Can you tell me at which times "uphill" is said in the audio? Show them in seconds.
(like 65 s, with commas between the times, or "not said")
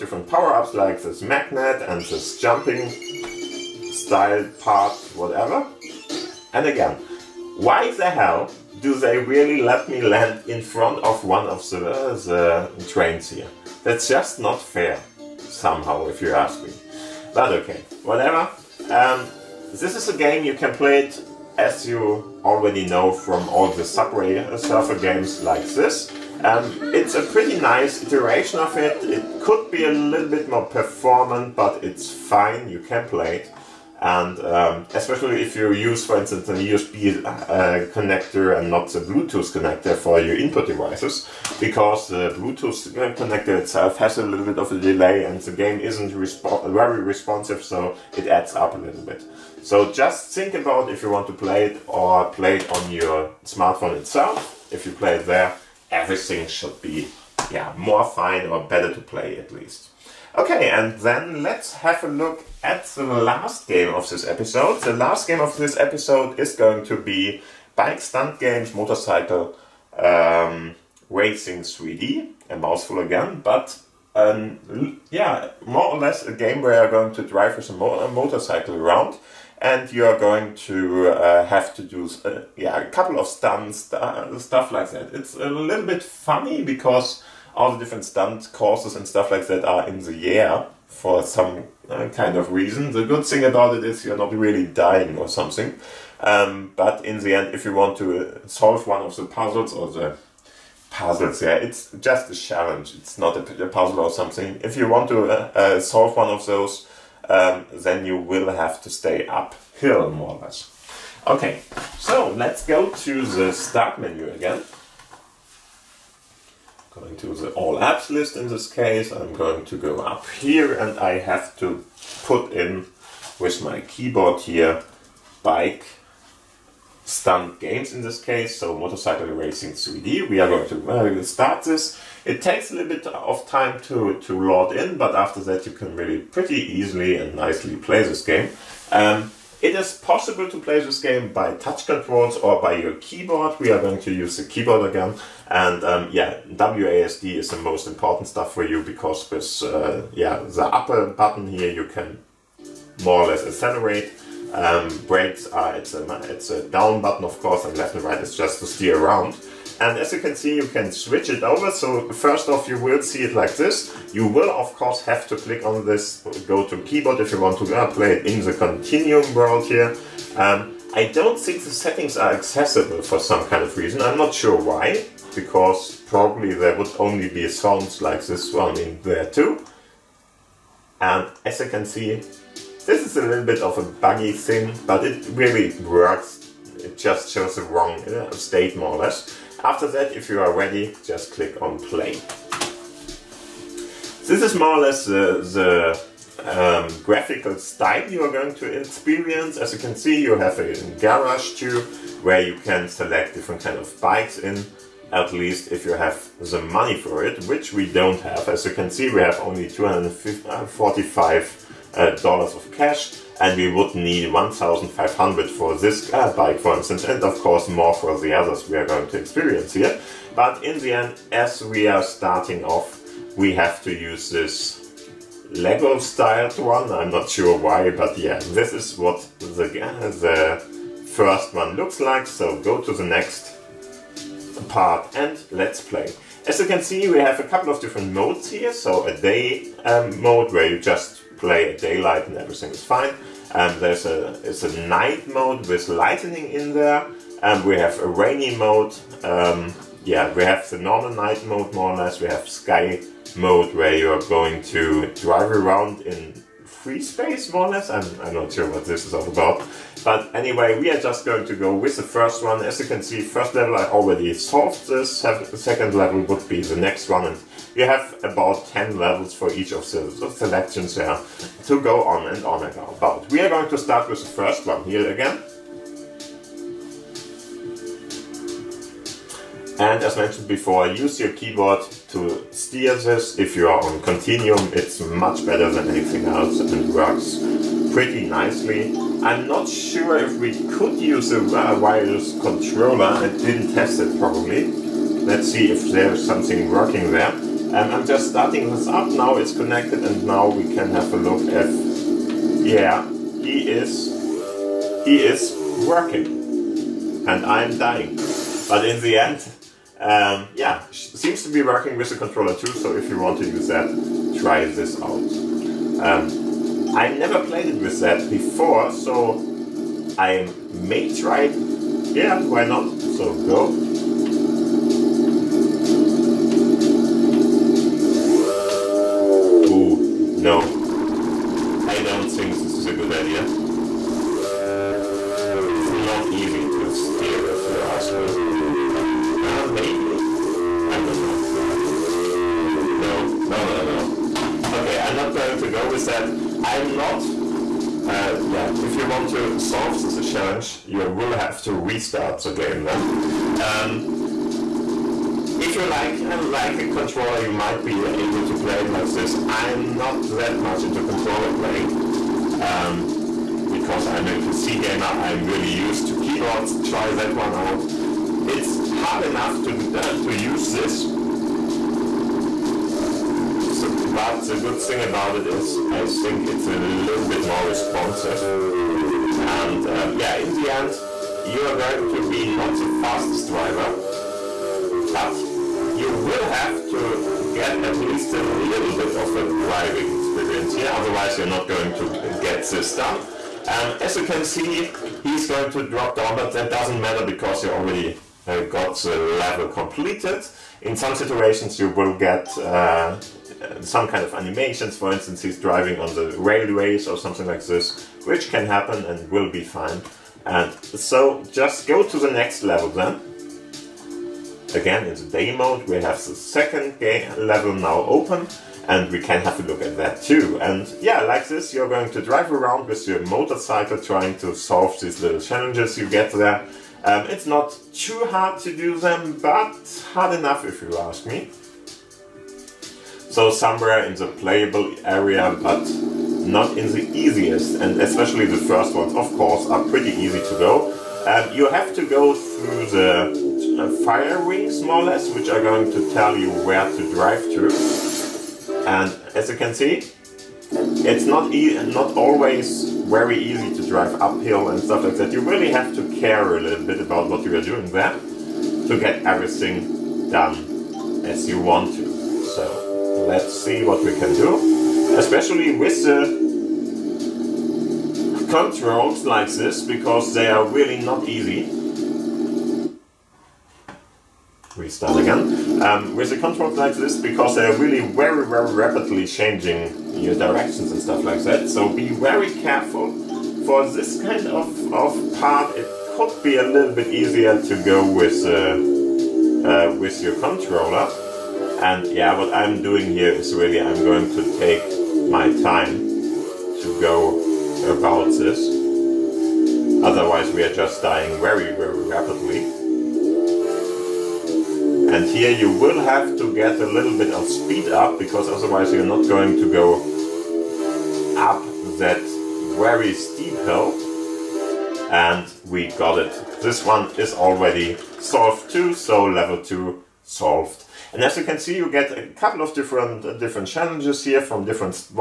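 109 s, 454 s.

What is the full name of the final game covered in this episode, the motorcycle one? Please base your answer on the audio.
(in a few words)
Bike Stunt Games Motorcycle Racing 3D.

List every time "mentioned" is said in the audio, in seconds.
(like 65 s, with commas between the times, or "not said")
280 s.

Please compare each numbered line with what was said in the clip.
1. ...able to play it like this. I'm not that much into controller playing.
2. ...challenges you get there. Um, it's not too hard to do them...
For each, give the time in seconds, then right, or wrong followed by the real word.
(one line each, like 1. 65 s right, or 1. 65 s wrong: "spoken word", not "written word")
1. 358 s right
2. 425 s right.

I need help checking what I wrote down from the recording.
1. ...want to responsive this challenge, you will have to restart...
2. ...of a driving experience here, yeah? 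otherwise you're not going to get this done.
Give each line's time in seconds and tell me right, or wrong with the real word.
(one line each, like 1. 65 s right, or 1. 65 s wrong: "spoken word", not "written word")
1. 349 s wrong: "solve", not "responsive"
2. 389 s right.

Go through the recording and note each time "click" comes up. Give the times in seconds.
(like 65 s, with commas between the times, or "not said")
165 s, 191 s.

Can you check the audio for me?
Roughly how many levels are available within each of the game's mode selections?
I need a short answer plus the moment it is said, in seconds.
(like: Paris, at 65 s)
10, at 268 s.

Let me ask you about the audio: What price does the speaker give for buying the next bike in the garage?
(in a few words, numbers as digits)
1500.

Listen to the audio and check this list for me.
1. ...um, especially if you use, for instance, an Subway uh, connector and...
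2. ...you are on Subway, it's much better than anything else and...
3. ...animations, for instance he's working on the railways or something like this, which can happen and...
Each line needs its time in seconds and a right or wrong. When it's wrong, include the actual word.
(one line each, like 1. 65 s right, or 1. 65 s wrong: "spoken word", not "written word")
1. 34 s wrong: "USB", not "Subway"
2. 283 s wrong: "Continuum", not "Subway"
3. 404 s wrong: "driving", not "working".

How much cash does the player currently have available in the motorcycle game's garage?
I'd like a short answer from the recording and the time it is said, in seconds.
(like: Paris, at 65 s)
$245, at 209 s.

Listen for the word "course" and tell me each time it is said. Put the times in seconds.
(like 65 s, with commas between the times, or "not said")
88 s, 157 s, 164 s, 217 s, 439 s.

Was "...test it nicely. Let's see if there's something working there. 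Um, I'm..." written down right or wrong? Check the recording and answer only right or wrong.
wrong.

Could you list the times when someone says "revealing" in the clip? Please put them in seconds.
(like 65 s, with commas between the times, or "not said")
not said.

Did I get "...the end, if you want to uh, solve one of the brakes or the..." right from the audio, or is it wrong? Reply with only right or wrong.
wrong.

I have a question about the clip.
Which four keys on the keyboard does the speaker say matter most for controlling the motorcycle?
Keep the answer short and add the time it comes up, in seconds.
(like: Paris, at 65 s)
WASD, at 146 s.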